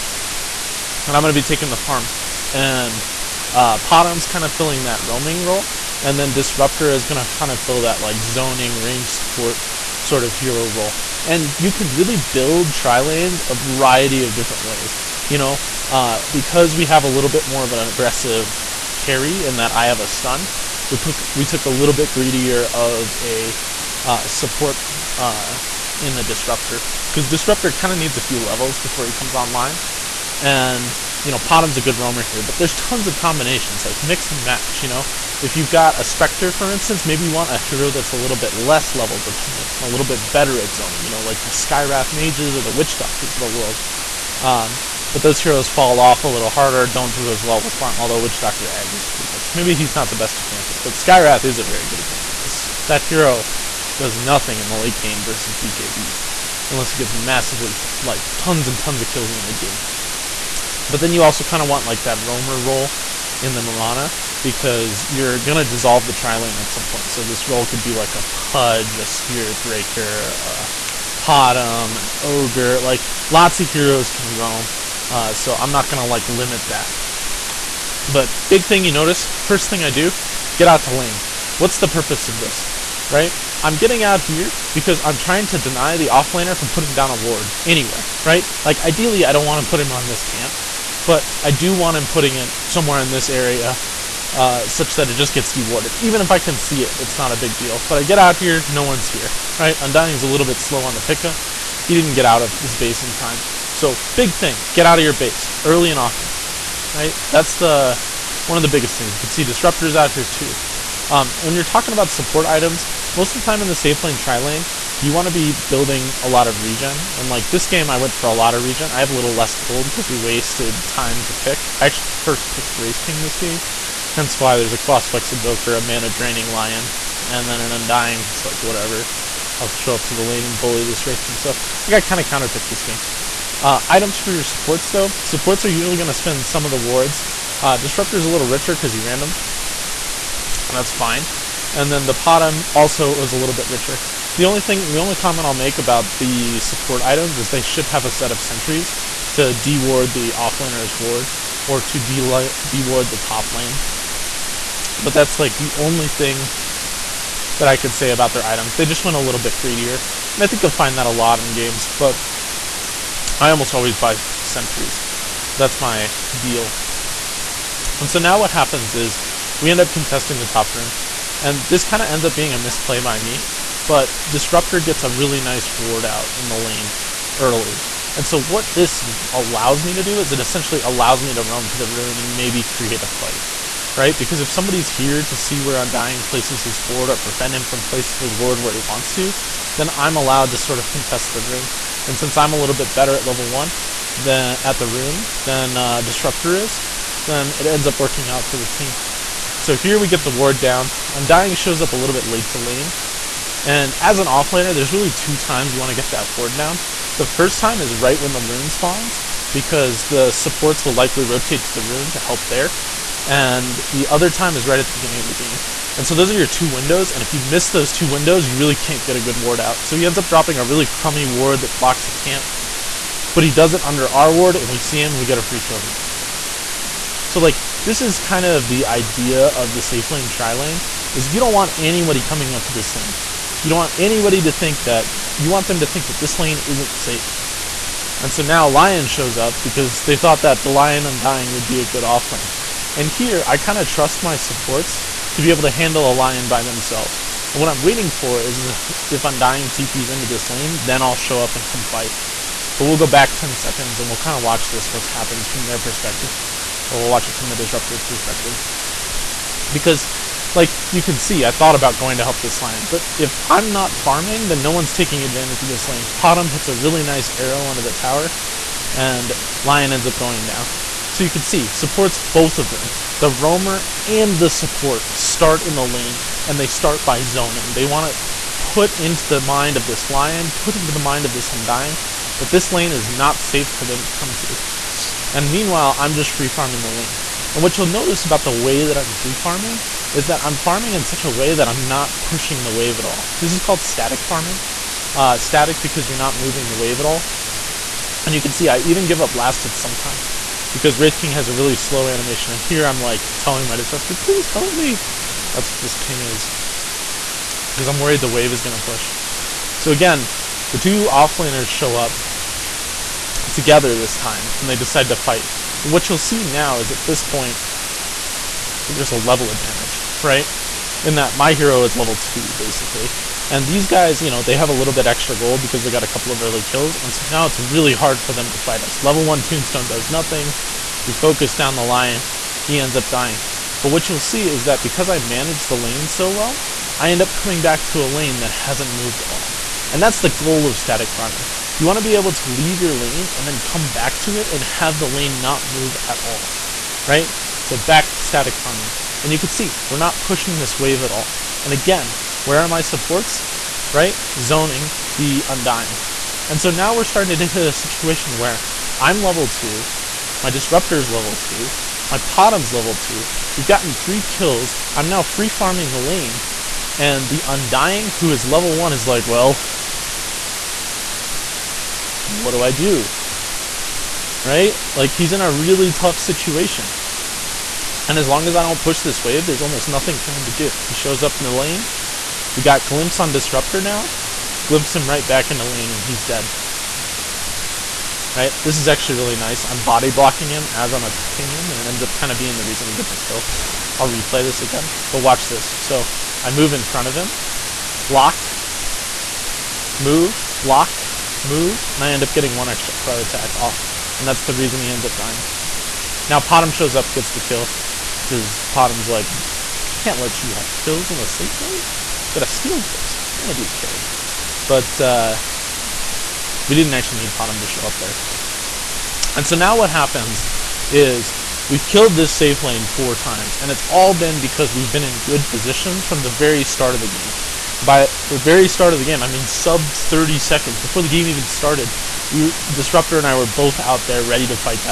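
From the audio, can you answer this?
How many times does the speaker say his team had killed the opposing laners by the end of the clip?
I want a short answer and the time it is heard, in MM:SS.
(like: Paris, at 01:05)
4, at 07:01.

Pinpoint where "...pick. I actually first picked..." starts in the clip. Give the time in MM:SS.
02:01.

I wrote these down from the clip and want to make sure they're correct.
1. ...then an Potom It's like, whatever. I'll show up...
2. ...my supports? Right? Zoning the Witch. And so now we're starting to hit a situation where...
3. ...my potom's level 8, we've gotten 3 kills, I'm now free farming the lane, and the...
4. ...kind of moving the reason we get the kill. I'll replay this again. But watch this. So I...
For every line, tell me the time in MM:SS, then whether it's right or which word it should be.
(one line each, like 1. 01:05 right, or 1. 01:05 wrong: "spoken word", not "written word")
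1. 02:07 wrong: "Undying", not "Potom"
2. 05:52 wrong: "Undying", not "Witch"
3. 06:02 wrong: "2", not "8"
4. 06:32 wrong: "being", not "moving".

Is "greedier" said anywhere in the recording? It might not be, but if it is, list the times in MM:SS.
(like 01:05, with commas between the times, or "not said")
00:22, 02:39.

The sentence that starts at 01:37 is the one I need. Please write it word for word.
But I get out here, no one's here, right?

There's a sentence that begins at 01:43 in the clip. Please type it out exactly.
So, big thing, get out of your base, early and often, right?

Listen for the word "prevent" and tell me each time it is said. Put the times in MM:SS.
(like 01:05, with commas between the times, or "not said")
03:07.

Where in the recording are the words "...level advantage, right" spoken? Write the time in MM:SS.
05:19.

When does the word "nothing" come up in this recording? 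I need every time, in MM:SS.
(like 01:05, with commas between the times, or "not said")
00:54, 05:30, 06:19.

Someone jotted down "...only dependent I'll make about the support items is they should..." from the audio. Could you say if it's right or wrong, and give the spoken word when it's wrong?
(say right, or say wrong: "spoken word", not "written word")
wrong: "comment", not "dependent".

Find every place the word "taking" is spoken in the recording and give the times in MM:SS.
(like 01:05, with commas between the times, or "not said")
00:01, 04:24.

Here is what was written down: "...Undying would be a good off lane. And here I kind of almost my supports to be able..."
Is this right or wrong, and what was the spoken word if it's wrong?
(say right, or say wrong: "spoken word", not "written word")
wrong: "trust", not "almost".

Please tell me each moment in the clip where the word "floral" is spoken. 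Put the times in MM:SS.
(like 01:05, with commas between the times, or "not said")
not said.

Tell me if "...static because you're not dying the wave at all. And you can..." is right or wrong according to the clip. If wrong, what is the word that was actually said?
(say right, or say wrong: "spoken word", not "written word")
wrong: "moving", not "dying".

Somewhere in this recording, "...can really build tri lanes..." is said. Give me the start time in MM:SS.
00:11.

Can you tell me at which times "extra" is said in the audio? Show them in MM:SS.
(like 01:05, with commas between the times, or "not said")
05:25, 06:42.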